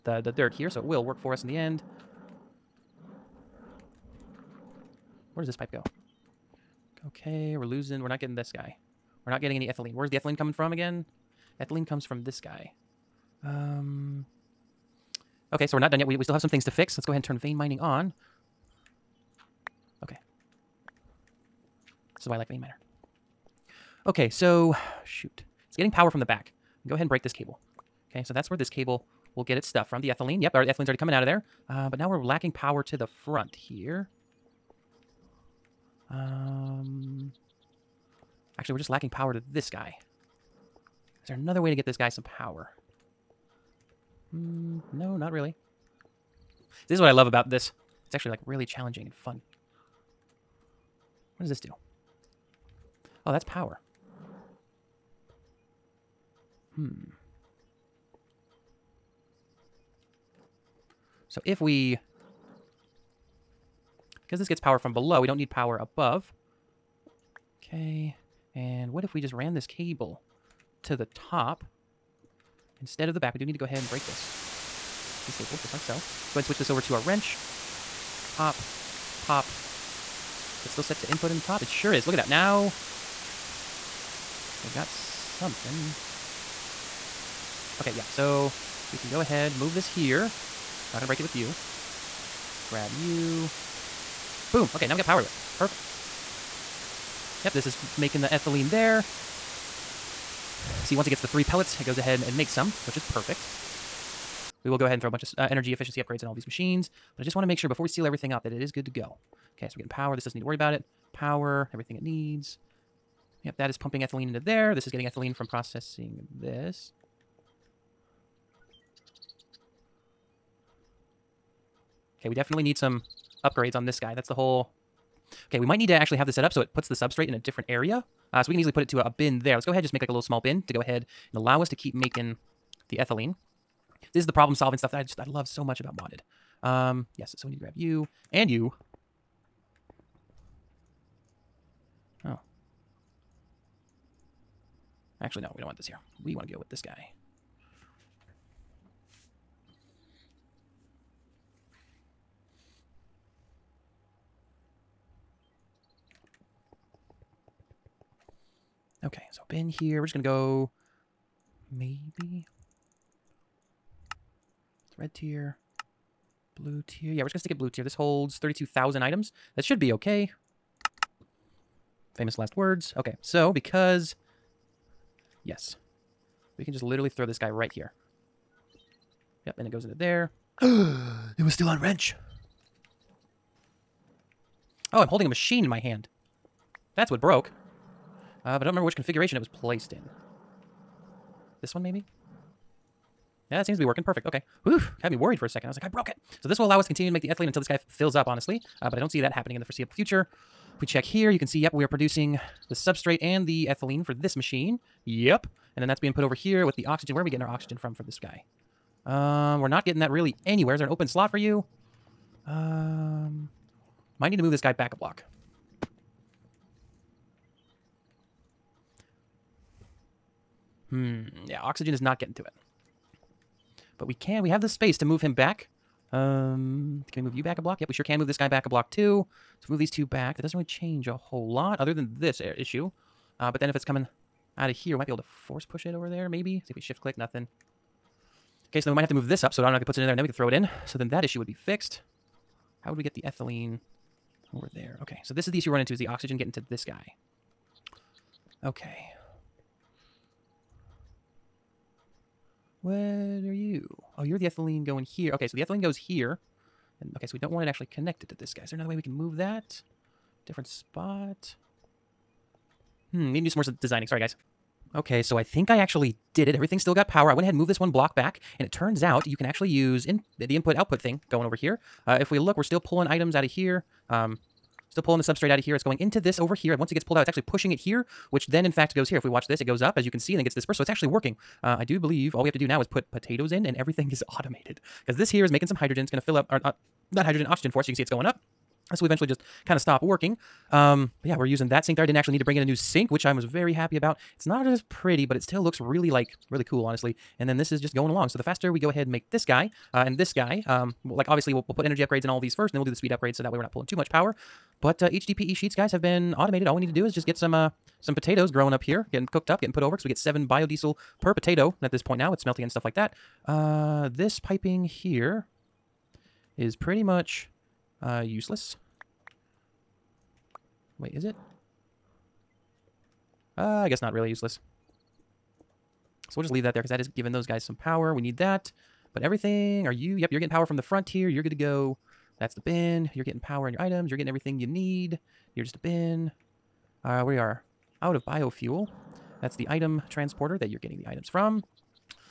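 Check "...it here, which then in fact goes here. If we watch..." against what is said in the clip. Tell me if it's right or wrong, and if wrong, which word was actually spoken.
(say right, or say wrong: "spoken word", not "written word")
right.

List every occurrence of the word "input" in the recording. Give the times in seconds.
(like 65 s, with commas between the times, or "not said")
81 s, 270 s.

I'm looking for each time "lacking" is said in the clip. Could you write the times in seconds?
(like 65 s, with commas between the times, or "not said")
32 s, 38 s.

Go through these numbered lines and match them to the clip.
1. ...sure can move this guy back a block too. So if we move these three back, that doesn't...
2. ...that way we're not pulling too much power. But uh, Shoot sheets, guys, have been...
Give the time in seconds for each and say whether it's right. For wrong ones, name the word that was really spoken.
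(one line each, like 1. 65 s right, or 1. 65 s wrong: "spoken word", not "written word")
1. 227 s wrong: "two", not "three"
2. 303 s wrong: "HDPE", not "Shoot".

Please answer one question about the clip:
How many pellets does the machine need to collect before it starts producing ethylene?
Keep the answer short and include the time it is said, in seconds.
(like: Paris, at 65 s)
3, at 101 s.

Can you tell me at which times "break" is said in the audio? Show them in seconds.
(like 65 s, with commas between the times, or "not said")
27 s, 73 s, 91 s.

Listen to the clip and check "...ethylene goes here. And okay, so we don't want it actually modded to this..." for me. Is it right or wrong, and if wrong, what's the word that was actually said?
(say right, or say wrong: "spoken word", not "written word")
wrong: "connected", not "modded".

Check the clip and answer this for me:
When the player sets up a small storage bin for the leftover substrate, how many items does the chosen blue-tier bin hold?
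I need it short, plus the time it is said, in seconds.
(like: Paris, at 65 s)
32,000, at 168 s.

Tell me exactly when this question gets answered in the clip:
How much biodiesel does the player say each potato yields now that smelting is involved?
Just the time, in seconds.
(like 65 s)
310 s.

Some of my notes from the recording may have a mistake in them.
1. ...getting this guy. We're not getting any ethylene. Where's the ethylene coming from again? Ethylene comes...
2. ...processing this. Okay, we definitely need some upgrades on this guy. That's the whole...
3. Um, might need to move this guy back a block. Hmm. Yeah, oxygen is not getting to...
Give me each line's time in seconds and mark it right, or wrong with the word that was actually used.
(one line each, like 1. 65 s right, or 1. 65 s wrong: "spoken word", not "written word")
1. 8 s right
2. 115 s right
3. 212 s right.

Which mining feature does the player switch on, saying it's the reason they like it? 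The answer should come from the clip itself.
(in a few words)
vein miner.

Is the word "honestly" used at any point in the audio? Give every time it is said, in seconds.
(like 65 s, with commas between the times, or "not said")
198 s, 296 s.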